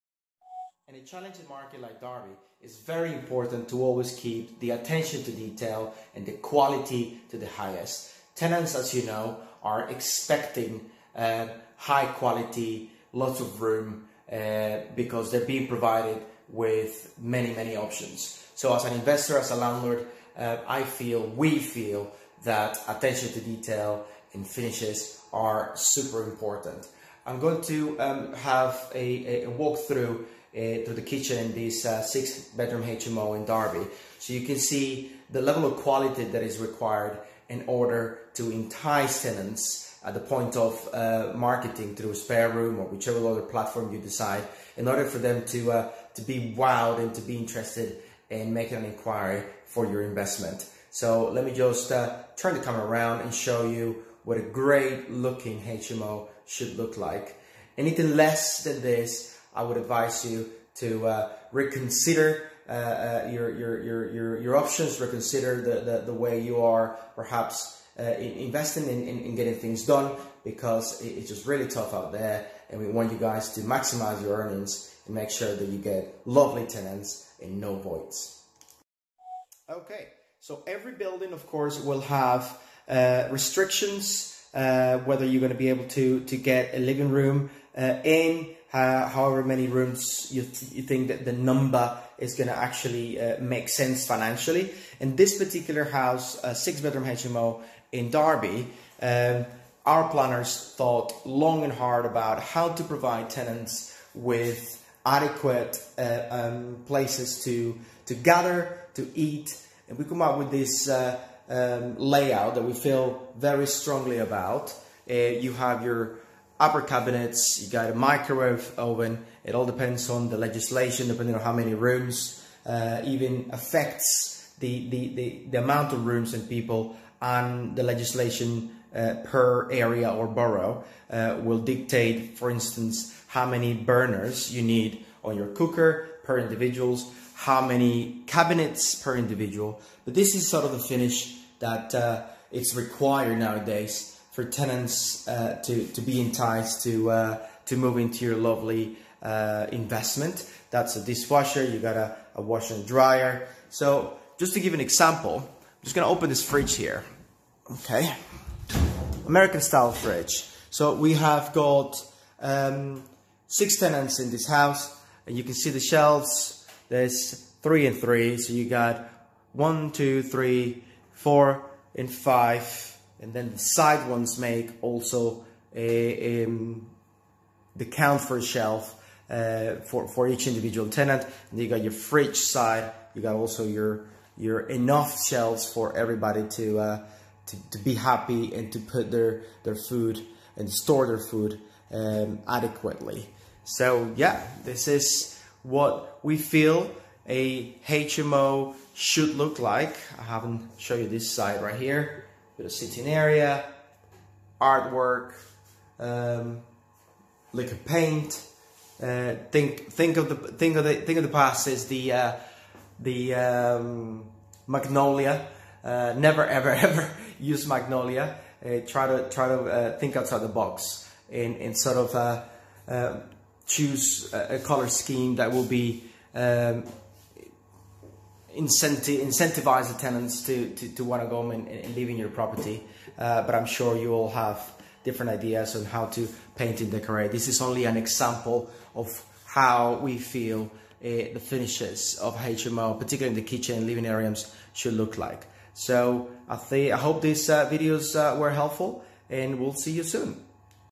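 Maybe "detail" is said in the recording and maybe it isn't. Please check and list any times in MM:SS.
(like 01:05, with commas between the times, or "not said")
00:05, 00:23.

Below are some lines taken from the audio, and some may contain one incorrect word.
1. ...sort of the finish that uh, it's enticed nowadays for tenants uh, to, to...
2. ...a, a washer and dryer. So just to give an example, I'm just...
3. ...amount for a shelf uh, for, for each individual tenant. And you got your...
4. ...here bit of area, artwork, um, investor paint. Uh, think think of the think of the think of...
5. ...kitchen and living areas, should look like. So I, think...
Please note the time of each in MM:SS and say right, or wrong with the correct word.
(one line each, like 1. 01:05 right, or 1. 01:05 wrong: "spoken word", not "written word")
1. 02:20 wrong: "required", not "enticed"
2. 02:31 right
3. 02:57 wrong: "count", not "amount"
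4. 03:21 wrong: "liquor", not "investor"
5. 04:03 right.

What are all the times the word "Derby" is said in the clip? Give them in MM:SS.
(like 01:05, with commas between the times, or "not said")
00:02, 00:33, 01:38.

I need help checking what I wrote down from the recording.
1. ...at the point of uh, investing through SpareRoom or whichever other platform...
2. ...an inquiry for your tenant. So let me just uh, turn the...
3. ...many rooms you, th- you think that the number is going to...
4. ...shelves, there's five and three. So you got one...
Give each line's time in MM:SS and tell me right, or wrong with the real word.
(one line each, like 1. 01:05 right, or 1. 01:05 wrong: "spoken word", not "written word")
1. 00:40 wrong: "marketing", not "investing"
2. 00:48 wrong: "investment", not "tenant"
3. 01:29 right
4. 02:45 wrong: "three", not "five".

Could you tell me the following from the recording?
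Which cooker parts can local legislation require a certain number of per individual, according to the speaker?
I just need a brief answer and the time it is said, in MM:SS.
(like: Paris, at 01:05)
Burners, at 02:13.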